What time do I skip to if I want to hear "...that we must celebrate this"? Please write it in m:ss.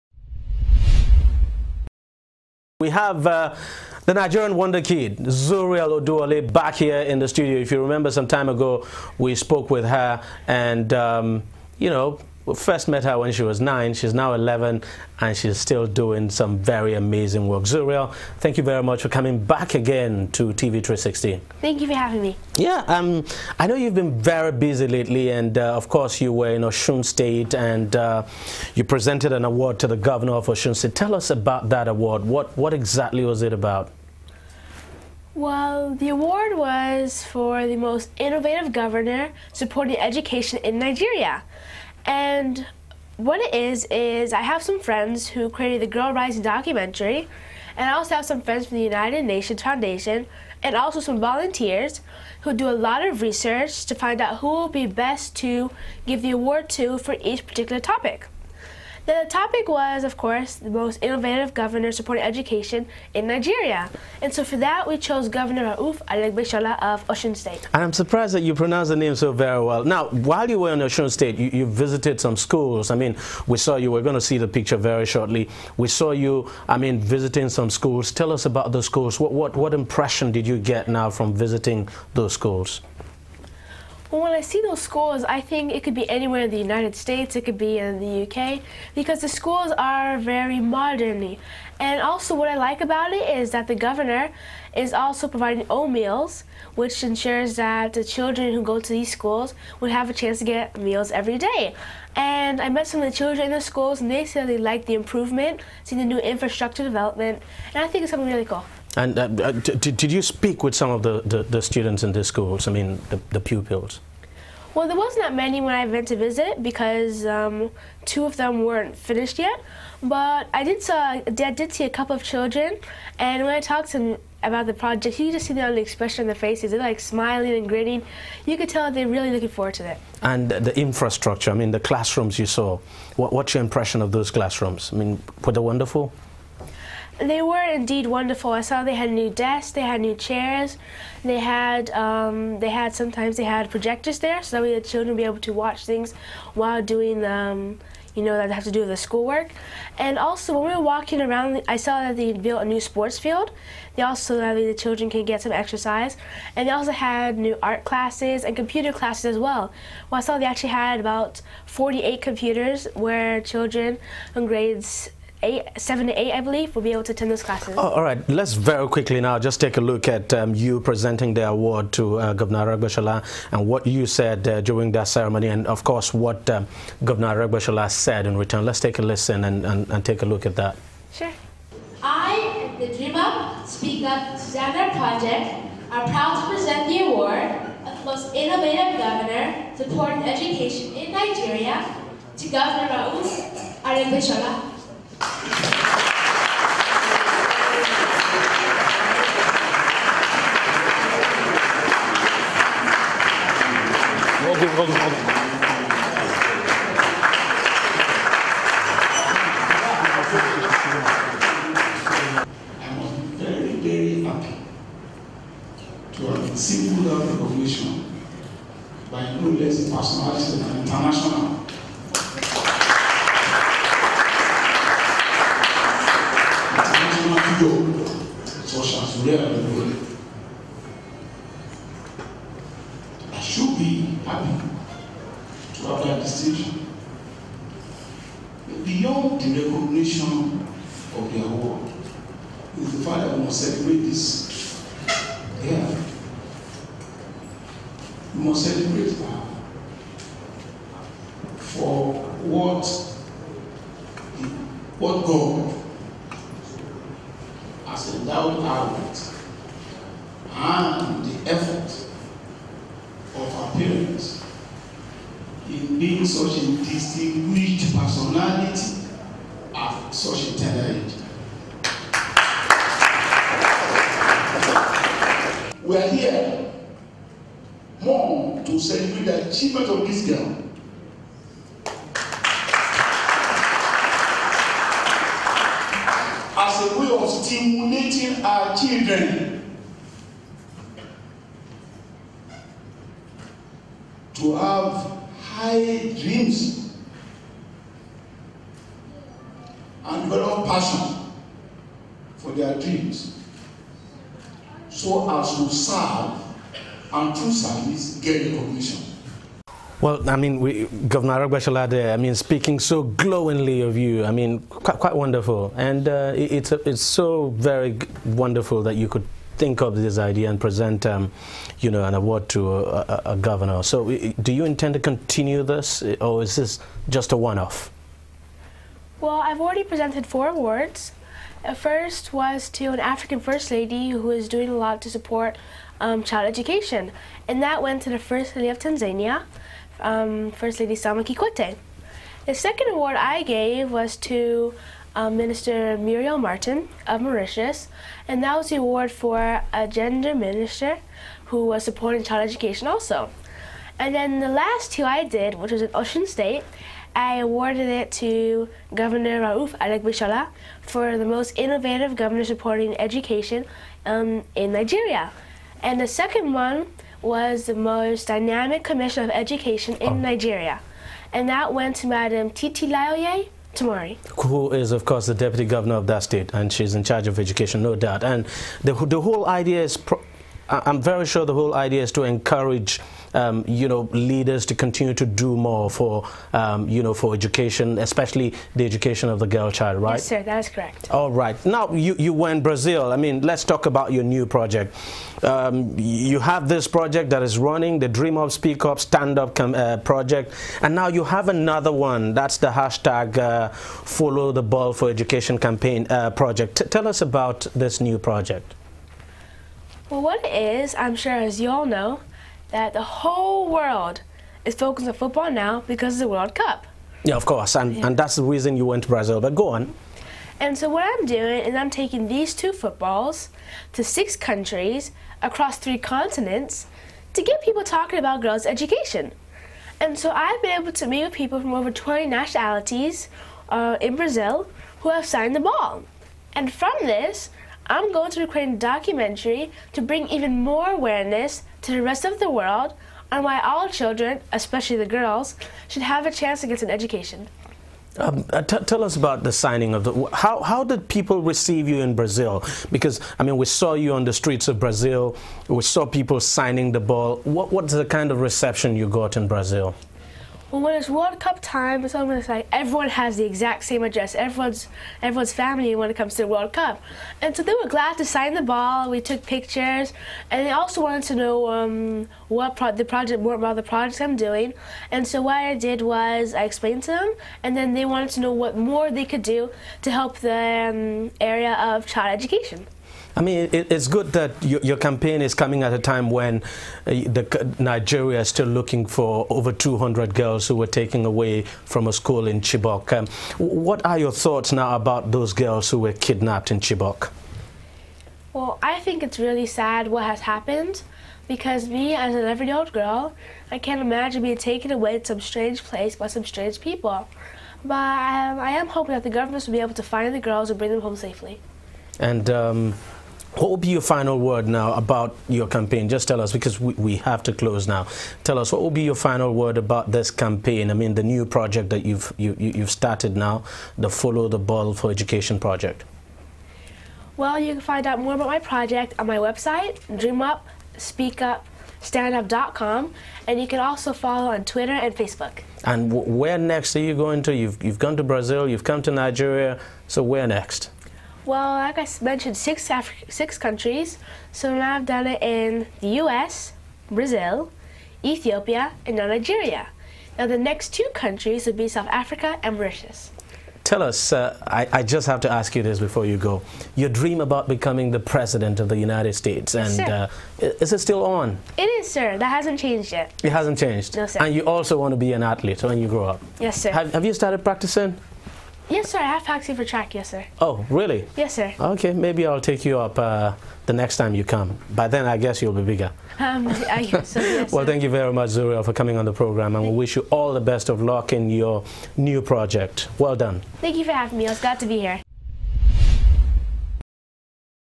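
4:03.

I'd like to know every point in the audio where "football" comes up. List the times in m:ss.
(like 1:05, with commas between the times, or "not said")
6:55, 7:02.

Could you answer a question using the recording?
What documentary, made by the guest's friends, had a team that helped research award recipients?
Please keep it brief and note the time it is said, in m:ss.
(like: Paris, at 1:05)
Girl Rising, at 0:45.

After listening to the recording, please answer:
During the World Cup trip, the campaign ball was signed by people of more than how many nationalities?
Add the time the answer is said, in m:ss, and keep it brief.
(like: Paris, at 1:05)
20, at 7:11.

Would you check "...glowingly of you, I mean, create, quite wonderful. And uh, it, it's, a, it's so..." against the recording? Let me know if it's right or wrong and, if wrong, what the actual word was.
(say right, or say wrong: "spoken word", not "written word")
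wrong: "quite", not "create".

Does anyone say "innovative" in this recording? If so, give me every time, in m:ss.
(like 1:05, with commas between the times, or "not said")
0:38, 1:01, 3:08, 6:01.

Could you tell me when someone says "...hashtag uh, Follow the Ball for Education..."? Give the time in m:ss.
6:42.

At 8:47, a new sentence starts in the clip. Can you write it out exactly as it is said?
Well, you can find out more about my project on my website, dreamupspeakupstandup.com, and you can also follow on Twitter and Facebook.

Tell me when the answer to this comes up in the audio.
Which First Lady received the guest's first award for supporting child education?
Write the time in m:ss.
5:41.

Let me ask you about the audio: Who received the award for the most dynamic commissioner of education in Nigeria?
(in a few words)
Titi Laoye Tomori.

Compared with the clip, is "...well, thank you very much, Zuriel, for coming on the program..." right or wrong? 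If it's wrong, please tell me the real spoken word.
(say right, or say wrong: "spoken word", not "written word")
right.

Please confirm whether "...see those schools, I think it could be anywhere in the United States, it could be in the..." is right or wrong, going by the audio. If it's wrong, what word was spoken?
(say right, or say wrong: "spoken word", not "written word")
right.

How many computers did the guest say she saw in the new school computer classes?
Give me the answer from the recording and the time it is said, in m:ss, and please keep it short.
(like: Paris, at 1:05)
48, at 2:41.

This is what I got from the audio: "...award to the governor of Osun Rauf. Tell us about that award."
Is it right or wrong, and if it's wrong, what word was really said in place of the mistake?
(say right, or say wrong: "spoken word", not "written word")
wrong: "State", not "Rauf".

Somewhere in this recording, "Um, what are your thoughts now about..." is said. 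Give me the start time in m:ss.
8:13.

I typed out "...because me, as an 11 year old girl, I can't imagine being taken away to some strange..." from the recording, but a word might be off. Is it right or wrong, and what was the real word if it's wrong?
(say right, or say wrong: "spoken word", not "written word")
right.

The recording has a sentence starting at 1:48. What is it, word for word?
And uh, uh did you speak with some of the, the, the, students in the schools, I mean, the, the pupils?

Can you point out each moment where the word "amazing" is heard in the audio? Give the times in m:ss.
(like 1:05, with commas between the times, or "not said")
0:16.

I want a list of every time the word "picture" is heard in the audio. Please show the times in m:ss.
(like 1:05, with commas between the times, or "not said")
1:14, 7:49.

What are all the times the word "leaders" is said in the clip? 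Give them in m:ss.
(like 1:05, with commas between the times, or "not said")
6:24.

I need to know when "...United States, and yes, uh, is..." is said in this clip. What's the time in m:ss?
9:18.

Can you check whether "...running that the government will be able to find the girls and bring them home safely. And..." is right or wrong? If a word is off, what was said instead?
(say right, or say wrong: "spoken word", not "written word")
wrong: "hoping", not "running".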